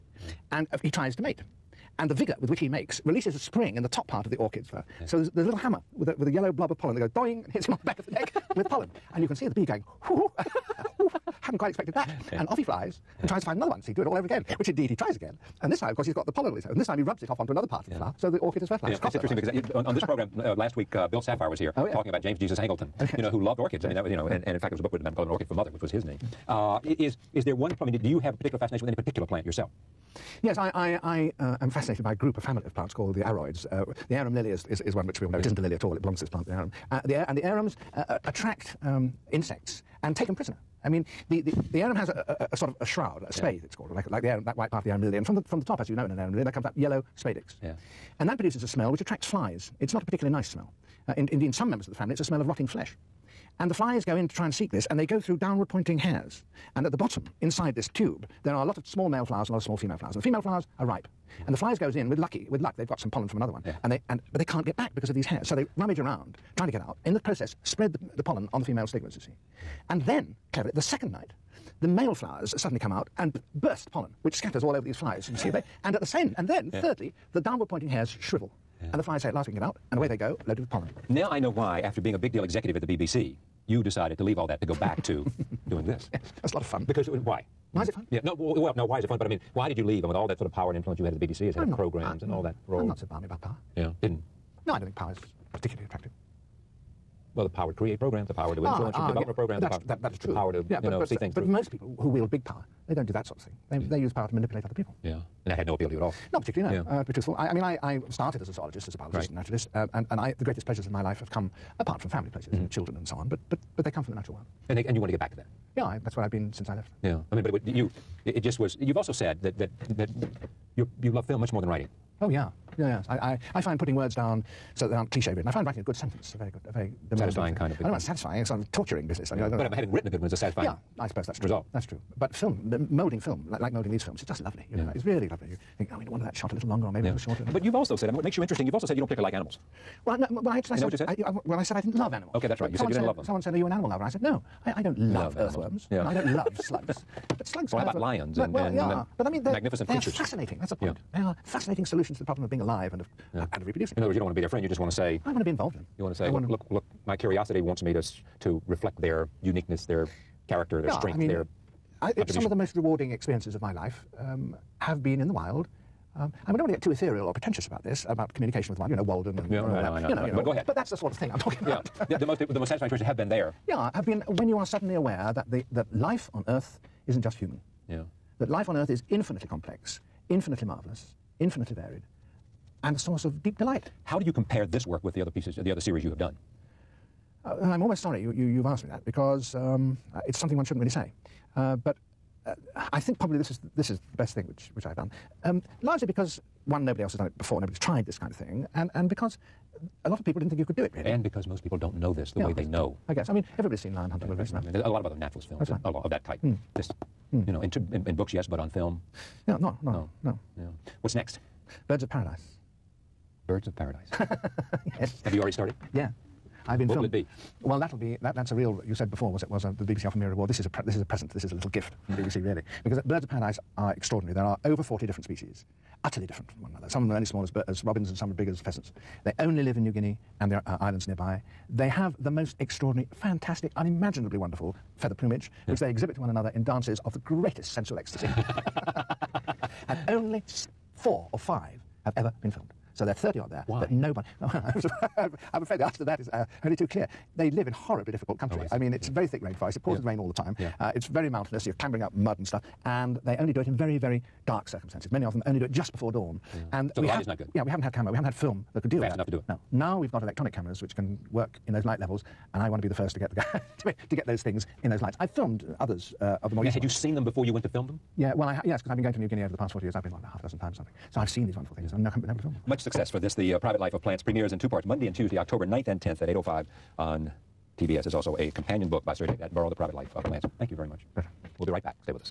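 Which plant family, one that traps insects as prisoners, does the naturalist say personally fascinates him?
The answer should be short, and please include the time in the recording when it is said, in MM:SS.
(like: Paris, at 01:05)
aroids, at 00:33.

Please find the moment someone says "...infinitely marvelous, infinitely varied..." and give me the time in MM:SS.
03:00.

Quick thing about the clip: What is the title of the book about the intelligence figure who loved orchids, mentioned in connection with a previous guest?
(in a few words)
An Orchid for Mother.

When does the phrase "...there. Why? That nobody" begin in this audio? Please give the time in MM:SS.
04:03.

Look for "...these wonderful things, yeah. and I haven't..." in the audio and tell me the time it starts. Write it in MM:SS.
04:31.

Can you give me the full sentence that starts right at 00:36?
Uh, the and the arums uh, uh, attract um, insects and take them prisoner.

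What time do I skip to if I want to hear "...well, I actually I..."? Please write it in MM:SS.
02:20.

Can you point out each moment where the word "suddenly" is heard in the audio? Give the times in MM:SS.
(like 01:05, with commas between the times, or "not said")
01:12, 02:54.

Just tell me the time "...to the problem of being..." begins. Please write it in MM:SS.
02:32.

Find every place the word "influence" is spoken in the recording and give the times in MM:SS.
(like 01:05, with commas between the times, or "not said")
01:30, 01:38.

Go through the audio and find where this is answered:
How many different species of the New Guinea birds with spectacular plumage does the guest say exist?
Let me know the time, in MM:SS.
03:44.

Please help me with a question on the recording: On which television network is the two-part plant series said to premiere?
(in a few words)
TBS.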